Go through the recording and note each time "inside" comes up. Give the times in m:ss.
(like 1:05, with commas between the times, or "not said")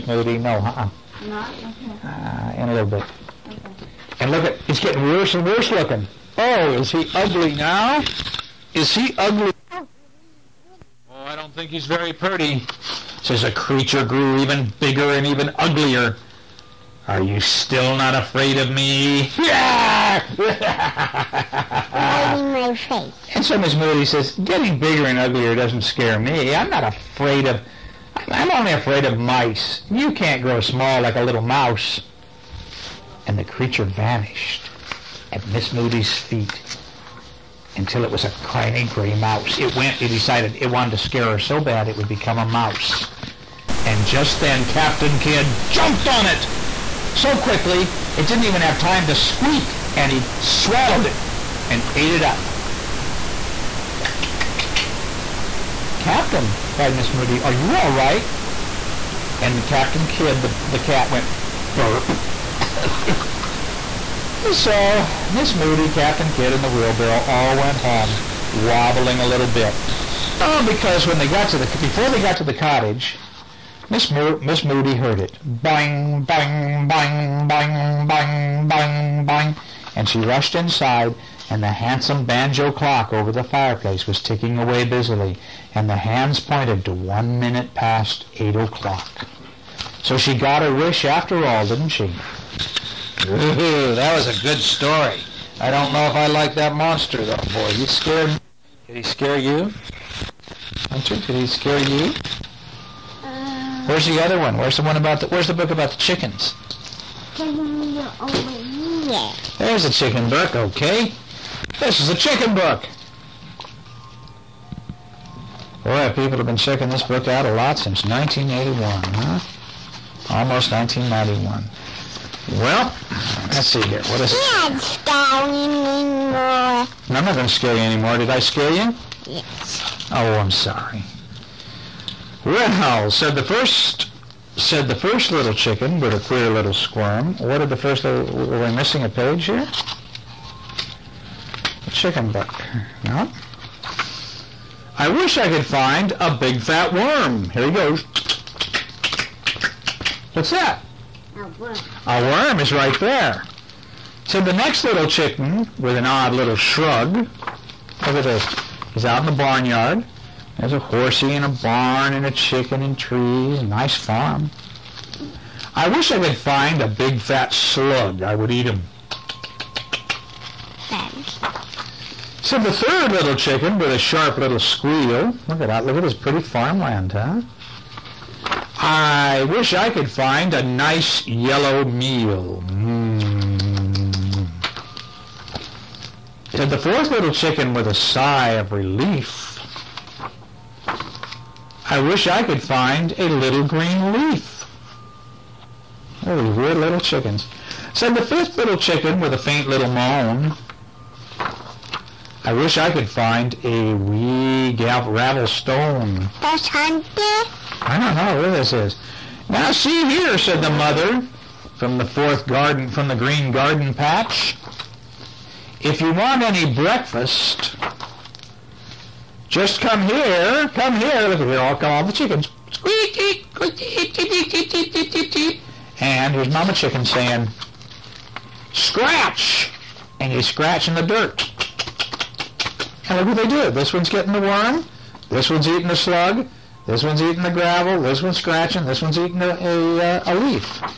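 1:20.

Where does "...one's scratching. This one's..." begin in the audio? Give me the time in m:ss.
3:58.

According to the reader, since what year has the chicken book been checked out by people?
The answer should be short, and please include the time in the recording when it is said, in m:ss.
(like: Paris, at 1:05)
1981, at 1:58.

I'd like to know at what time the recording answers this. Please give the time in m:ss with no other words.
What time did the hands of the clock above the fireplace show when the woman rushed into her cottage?
1:26.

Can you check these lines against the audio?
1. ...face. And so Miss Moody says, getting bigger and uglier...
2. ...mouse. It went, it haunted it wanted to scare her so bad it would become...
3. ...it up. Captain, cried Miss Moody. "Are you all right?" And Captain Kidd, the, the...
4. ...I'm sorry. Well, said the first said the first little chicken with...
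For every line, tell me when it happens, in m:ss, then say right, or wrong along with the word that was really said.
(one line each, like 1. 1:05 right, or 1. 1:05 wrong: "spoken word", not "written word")
1. 0:22 right
2. 0:39 wrong: "decided", not "haunted"
3. 0:52 right
4. 2:10 right.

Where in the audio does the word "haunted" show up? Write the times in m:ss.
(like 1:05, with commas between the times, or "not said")
3:26.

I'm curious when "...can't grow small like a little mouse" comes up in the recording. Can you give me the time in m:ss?
0:30.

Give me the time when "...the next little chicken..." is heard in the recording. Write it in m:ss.
2:34.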